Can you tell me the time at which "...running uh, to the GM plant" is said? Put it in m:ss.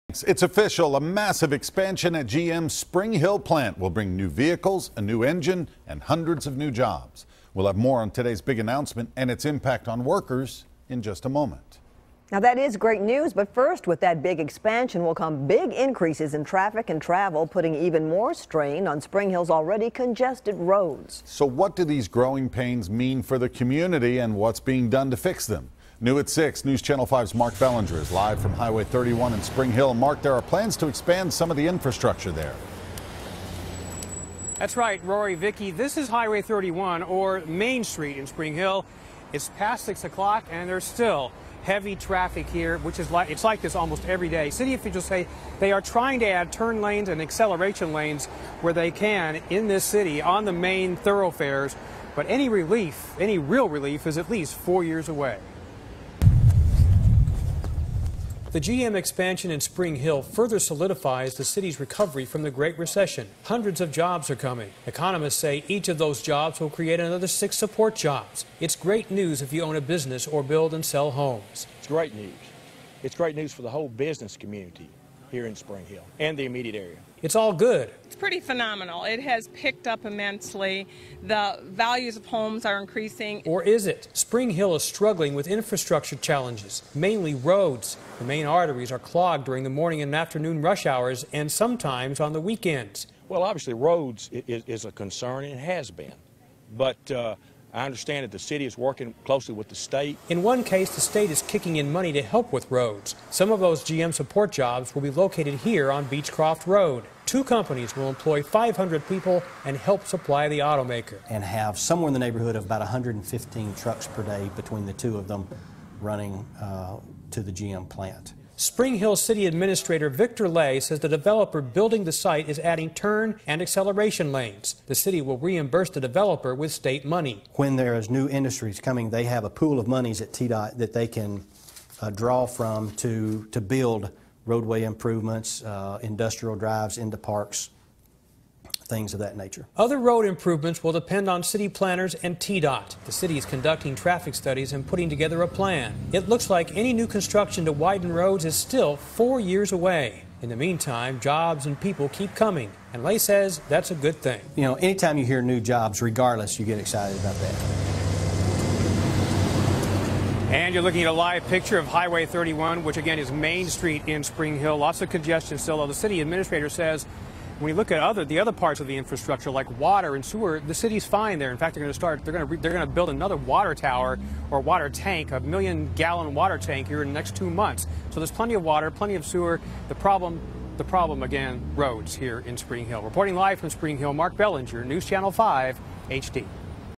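1:56.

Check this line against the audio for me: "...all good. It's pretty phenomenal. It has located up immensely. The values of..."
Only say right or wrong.
wrong.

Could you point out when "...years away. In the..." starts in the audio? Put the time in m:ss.
2:29.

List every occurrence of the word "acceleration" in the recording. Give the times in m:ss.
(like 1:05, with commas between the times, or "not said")
0:47, 2:03.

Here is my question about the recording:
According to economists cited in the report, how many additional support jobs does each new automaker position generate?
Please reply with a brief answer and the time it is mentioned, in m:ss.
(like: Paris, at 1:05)
6, at 1:07.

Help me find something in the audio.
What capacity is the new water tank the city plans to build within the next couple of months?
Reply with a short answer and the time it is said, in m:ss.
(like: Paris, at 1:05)
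1 million gallons, at 2:55.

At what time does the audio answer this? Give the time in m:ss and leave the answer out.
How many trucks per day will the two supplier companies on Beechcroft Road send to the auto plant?
1:52.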